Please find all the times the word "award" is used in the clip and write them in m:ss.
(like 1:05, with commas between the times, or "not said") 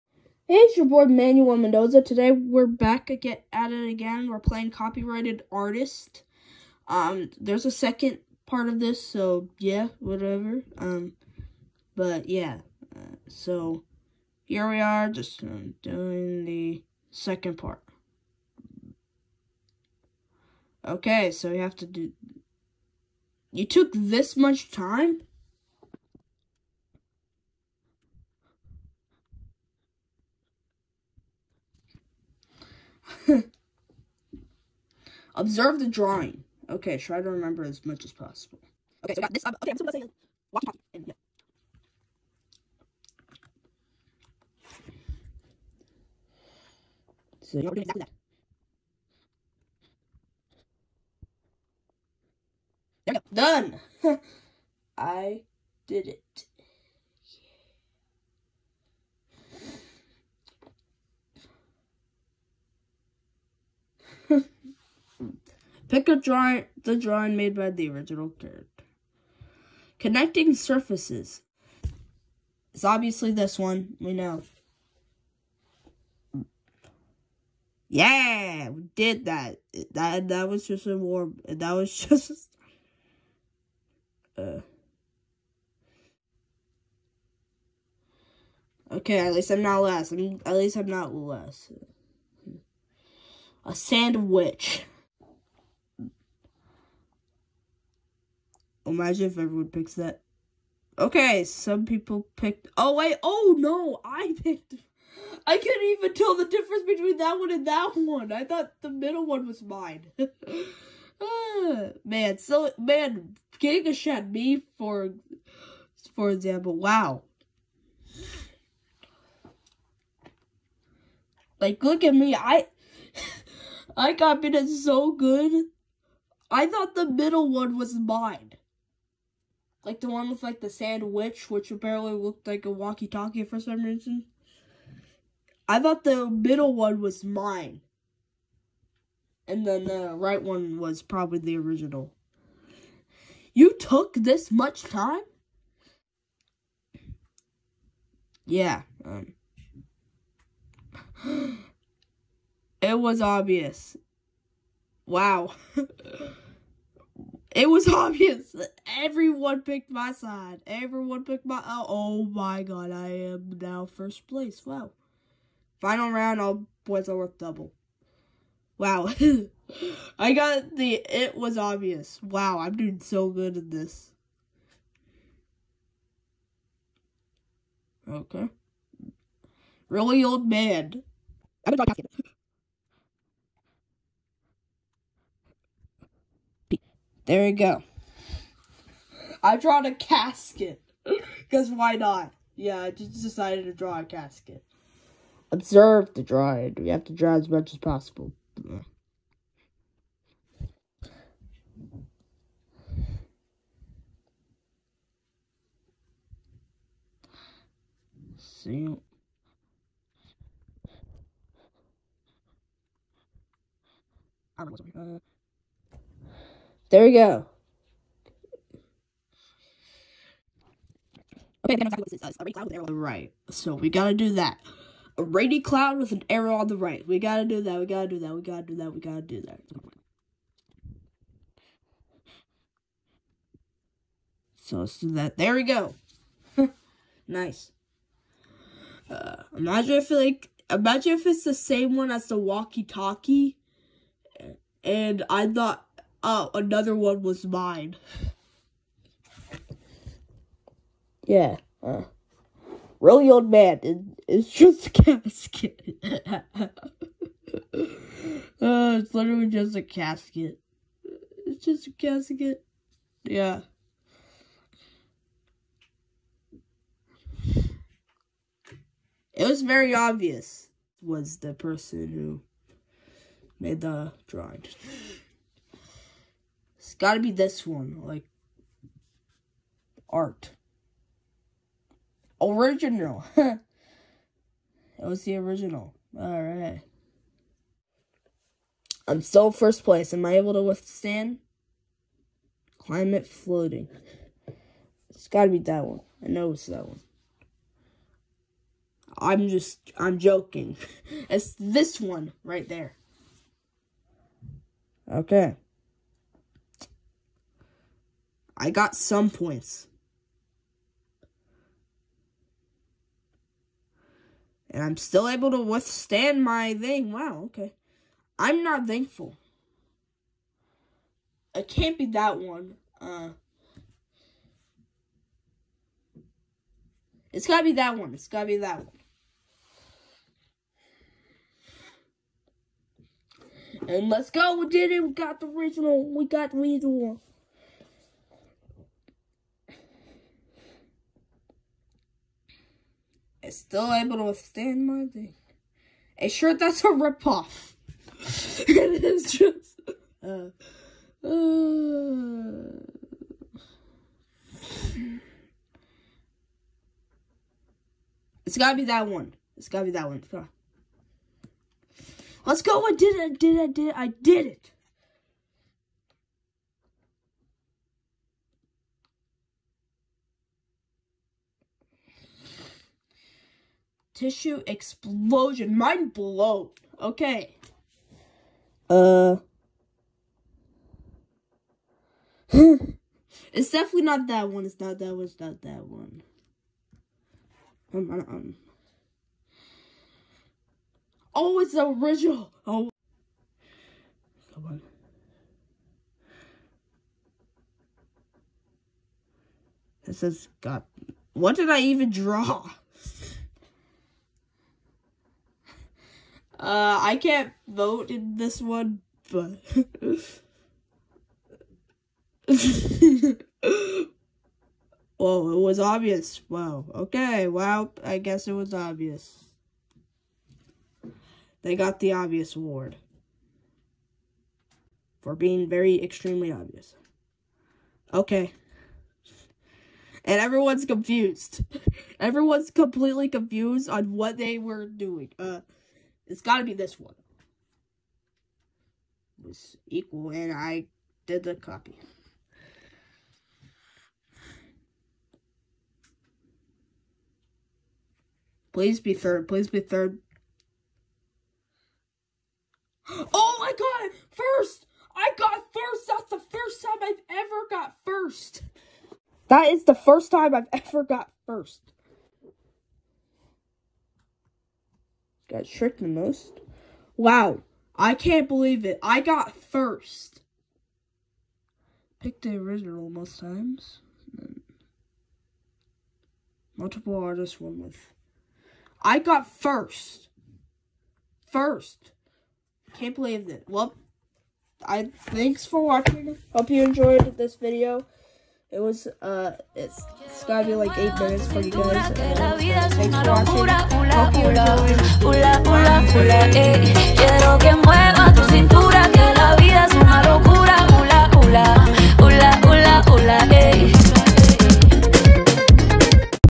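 7:02.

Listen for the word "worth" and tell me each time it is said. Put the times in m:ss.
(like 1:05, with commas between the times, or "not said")
2:47.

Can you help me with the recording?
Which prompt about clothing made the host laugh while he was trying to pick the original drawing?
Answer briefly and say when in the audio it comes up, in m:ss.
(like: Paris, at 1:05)
A shirt that's a ripoff, at 5:46.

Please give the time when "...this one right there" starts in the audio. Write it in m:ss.
5:01.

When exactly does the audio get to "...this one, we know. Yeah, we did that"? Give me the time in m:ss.
1:13.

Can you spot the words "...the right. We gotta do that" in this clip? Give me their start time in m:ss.
3:46.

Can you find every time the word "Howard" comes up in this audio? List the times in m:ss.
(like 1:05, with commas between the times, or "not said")
not said.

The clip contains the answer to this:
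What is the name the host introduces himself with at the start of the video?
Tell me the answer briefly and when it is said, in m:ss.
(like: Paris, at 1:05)
Manuel Mendoza, at 0:01.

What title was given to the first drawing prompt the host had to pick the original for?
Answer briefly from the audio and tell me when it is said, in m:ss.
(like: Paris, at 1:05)
Connecting surfaces, at 1:09.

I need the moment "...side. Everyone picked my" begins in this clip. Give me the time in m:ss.
2:40.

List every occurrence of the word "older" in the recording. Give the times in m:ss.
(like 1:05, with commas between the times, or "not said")
not said.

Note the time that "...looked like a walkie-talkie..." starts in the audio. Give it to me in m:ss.
2:12.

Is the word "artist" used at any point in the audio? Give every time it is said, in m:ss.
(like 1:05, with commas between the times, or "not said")
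0:05, 7:57.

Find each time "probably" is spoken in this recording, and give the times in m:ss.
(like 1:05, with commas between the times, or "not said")
2:21.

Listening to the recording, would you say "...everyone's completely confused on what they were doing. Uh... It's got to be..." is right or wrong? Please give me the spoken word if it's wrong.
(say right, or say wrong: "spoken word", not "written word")
right.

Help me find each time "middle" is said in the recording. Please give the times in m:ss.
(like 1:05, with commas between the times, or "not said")
1:48, 2:07, 2:16.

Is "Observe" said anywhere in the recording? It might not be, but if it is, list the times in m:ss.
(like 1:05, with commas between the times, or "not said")
0:35, 3:15.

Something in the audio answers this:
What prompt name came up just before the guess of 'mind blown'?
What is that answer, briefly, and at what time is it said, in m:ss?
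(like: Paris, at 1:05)
tissue explosion, at 6:14.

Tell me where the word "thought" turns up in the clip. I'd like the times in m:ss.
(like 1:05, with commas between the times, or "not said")
1:48, 2:06, 2:15, 4:05.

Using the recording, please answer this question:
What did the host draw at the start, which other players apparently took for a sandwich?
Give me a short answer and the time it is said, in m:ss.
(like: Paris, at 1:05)
walkie talkie, at 0:40.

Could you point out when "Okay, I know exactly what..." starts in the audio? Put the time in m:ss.
3:41.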